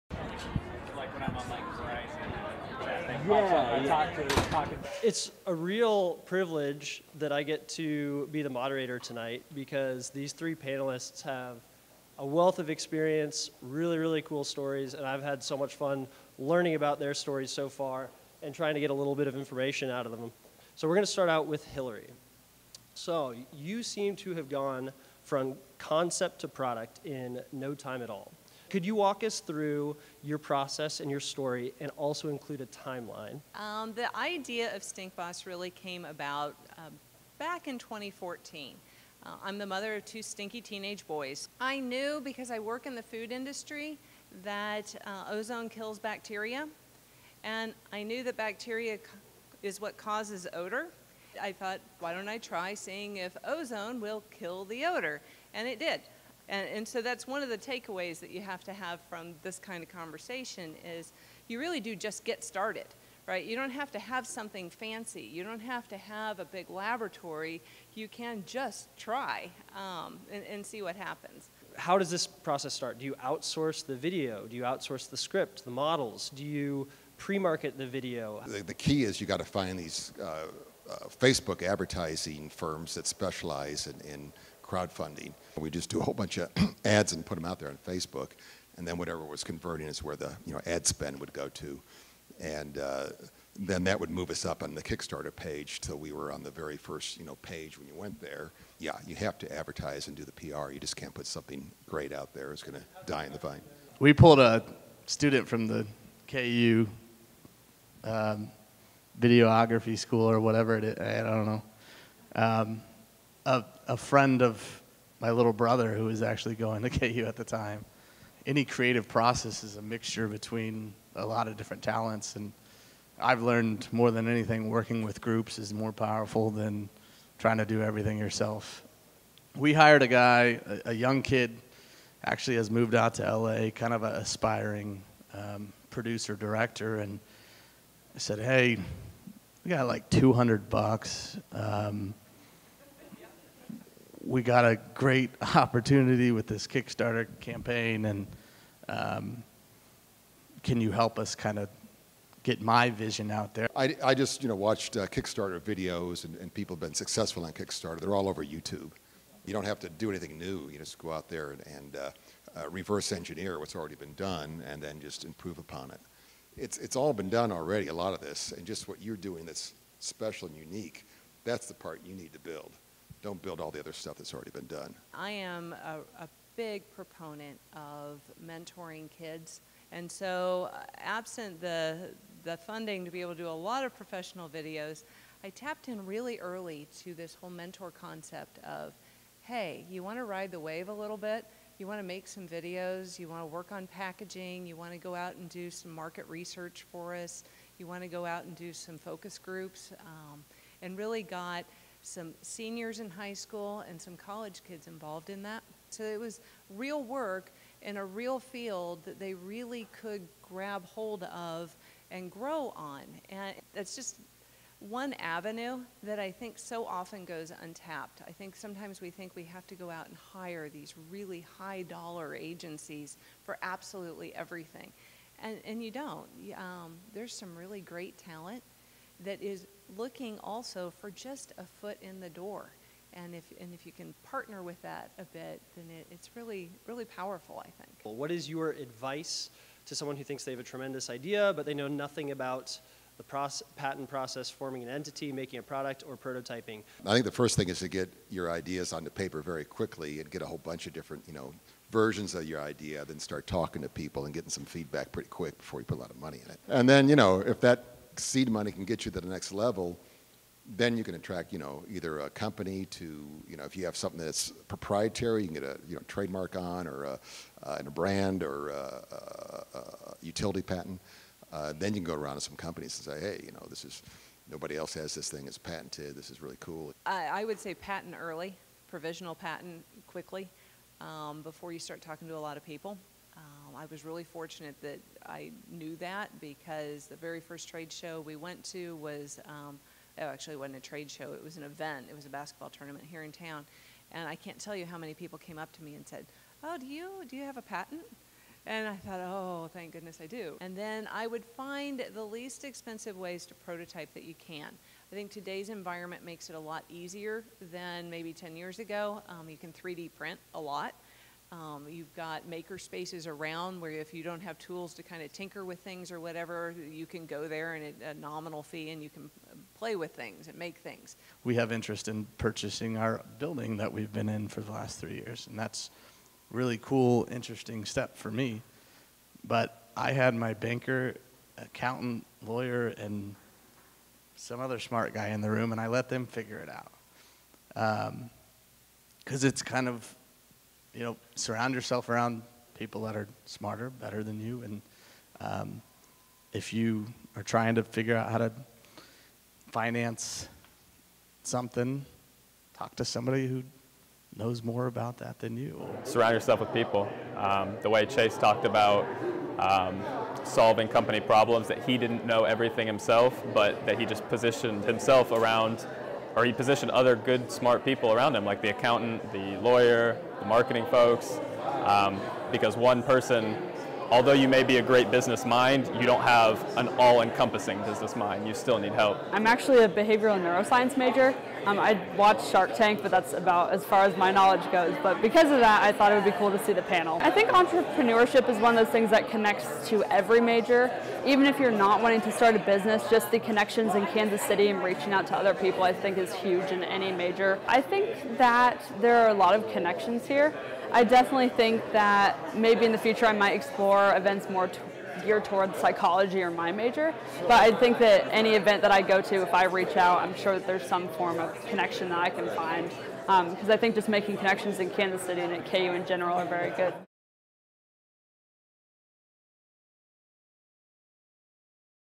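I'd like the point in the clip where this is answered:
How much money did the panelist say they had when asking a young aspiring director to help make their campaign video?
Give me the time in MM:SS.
02:20.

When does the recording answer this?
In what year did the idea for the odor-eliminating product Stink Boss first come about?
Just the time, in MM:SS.
00:37.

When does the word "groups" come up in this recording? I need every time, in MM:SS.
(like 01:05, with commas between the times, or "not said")
02:05, 03:19.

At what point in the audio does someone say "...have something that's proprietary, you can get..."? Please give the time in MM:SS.
04:23.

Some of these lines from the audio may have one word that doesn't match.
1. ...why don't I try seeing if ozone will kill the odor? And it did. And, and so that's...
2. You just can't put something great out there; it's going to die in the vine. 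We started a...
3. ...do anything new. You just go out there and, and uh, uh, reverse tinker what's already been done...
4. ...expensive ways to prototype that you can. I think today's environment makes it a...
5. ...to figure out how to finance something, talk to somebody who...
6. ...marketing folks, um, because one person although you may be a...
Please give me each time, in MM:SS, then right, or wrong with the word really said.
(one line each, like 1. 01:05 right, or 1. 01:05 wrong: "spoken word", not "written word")
1. 00:51 right
2. 01:40 wrong: "pulled", not "started"
3. 02:39 wrong: "engineer", not "tinker"
4. 05:02 right
5. 05:47 right
6. 06:10 right.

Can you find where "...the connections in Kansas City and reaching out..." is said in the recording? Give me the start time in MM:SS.
06:33.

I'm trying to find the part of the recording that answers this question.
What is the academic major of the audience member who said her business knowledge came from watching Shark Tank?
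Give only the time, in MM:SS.
06:19.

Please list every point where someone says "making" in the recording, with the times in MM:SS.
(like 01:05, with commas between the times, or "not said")
04:05, 06:54.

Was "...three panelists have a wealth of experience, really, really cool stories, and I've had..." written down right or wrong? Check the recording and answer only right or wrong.
right.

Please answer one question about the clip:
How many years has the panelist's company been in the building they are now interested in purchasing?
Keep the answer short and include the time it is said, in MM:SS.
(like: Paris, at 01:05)
3, at 05:25.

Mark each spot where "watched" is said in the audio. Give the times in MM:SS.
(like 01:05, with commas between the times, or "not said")
02:34, 06:22.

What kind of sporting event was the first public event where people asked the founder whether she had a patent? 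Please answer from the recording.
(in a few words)
A basketball tournament.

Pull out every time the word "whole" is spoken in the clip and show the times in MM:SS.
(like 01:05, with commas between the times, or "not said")
01:26, 03:07, 04:10.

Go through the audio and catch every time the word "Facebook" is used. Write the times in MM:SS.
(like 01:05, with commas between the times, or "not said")
01:21, 01:27.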